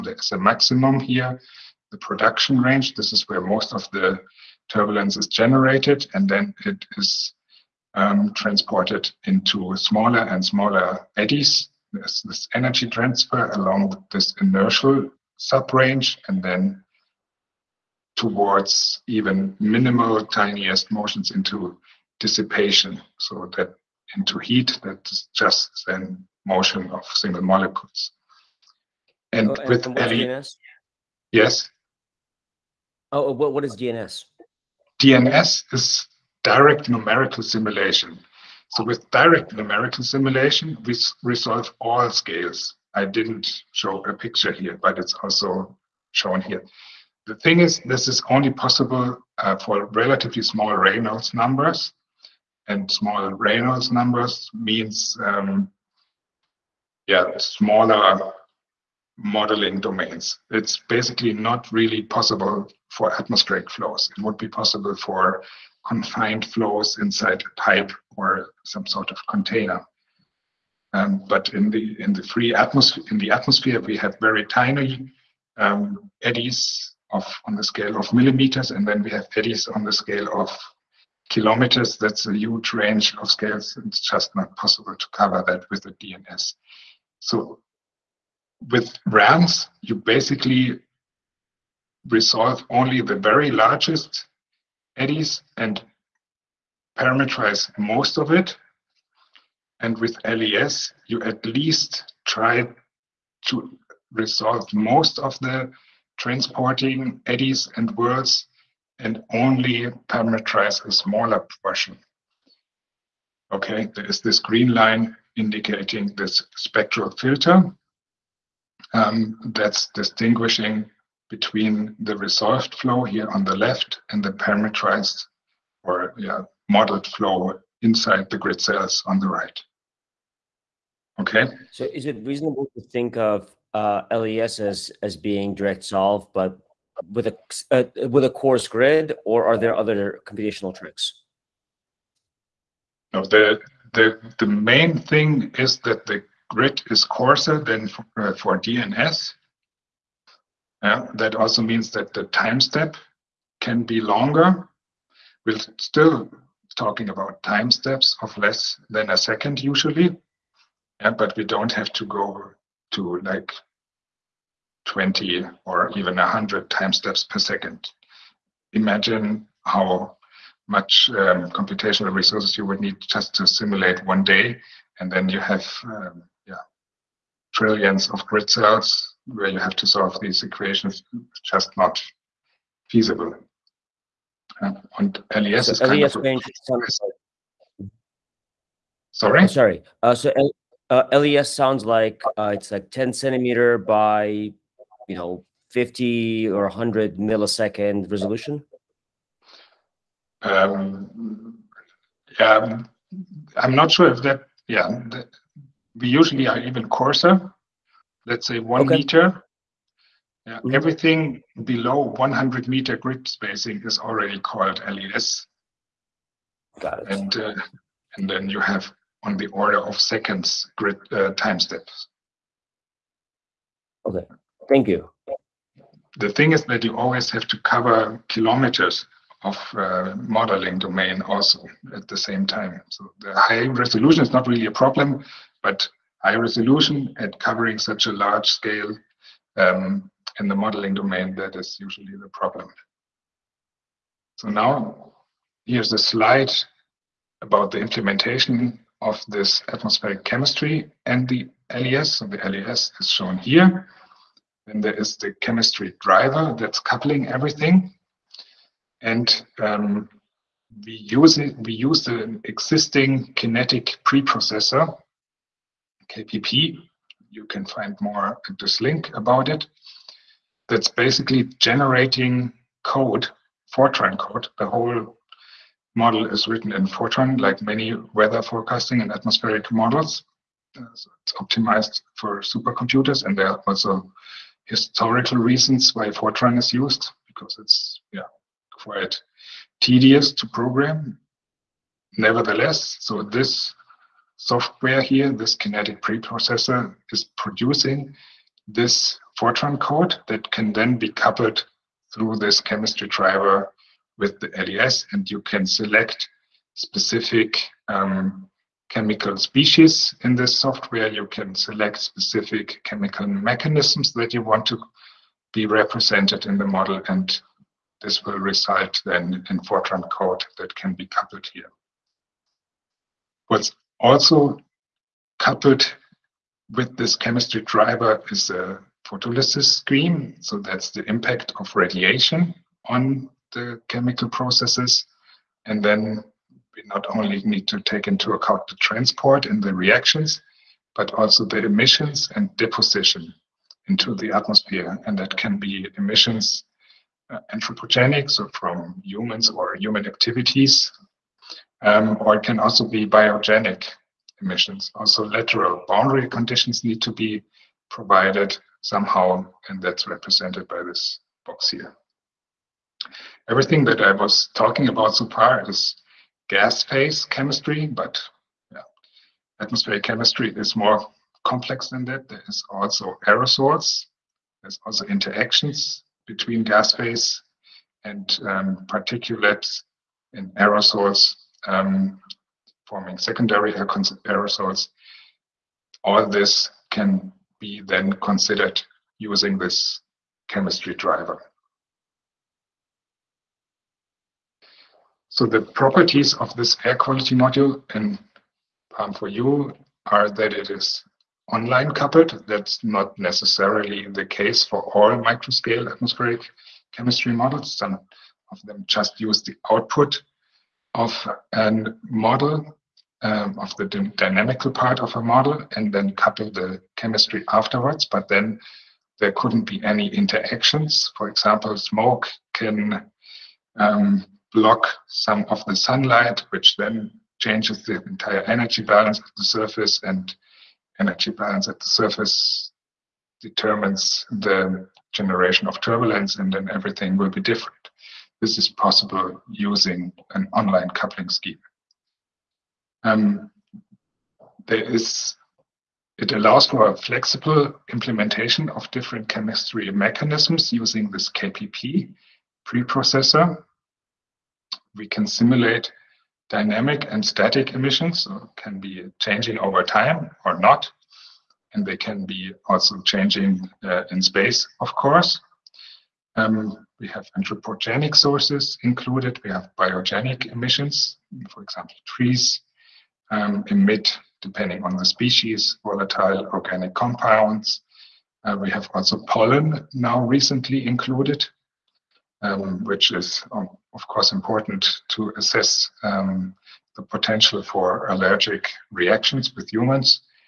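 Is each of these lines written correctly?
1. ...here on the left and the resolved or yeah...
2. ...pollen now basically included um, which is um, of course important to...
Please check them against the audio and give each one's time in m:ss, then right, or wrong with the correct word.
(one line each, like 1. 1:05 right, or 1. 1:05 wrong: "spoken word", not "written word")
1. 2:03 wrong: "parameterized", not "resolved"
2. 7:59 wrong: "recently", not "basically".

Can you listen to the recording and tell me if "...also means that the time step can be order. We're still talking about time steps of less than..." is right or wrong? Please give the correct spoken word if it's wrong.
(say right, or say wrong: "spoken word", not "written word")
wrong: "longer", not "order".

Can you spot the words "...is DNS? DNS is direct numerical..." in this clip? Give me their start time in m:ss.
0:33.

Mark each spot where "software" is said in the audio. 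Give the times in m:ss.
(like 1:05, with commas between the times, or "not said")
4:54, 5:10.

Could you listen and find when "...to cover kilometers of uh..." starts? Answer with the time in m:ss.
3:47.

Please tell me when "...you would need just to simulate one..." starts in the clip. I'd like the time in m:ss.
2:52.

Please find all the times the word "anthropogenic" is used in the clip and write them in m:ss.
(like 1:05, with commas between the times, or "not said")
5:47, 7:47.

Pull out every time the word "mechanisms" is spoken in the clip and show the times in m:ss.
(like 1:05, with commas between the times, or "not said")
5:13, 7:29.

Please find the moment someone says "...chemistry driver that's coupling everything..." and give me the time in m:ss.
4:15.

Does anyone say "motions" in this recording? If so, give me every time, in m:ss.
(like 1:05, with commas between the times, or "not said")
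0:20, 0:26.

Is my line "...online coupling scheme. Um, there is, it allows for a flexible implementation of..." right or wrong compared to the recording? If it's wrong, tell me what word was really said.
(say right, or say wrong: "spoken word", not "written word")
right.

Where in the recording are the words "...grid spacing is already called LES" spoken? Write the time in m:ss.
3:32.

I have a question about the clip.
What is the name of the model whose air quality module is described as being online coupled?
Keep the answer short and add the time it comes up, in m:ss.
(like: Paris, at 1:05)
Palm4U, at 6:38.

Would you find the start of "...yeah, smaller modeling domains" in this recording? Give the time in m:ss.
0:57.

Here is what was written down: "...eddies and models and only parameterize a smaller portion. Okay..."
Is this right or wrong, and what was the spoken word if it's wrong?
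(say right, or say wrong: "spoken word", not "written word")
wrong: "whirls", not "models".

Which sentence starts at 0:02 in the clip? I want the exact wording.
This is where most of the turbulence is generated, and then it is um, transported into smaller and smaller eddies.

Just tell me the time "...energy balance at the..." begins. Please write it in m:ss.
7:10.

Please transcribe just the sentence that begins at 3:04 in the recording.
Uh, and LES so is kind of range a, Sorry?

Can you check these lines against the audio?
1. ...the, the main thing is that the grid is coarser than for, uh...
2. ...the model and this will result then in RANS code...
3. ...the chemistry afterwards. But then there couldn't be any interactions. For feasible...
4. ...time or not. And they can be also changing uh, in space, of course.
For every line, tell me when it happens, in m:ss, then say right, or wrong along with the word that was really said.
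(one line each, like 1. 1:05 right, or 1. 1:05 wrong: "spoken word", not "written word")
1. 2:23 right
2. 5:16 wrong: "Fortran", not "RANS"
3. 6:56 wrong: "example", not "feasible"
4. 7:39 right.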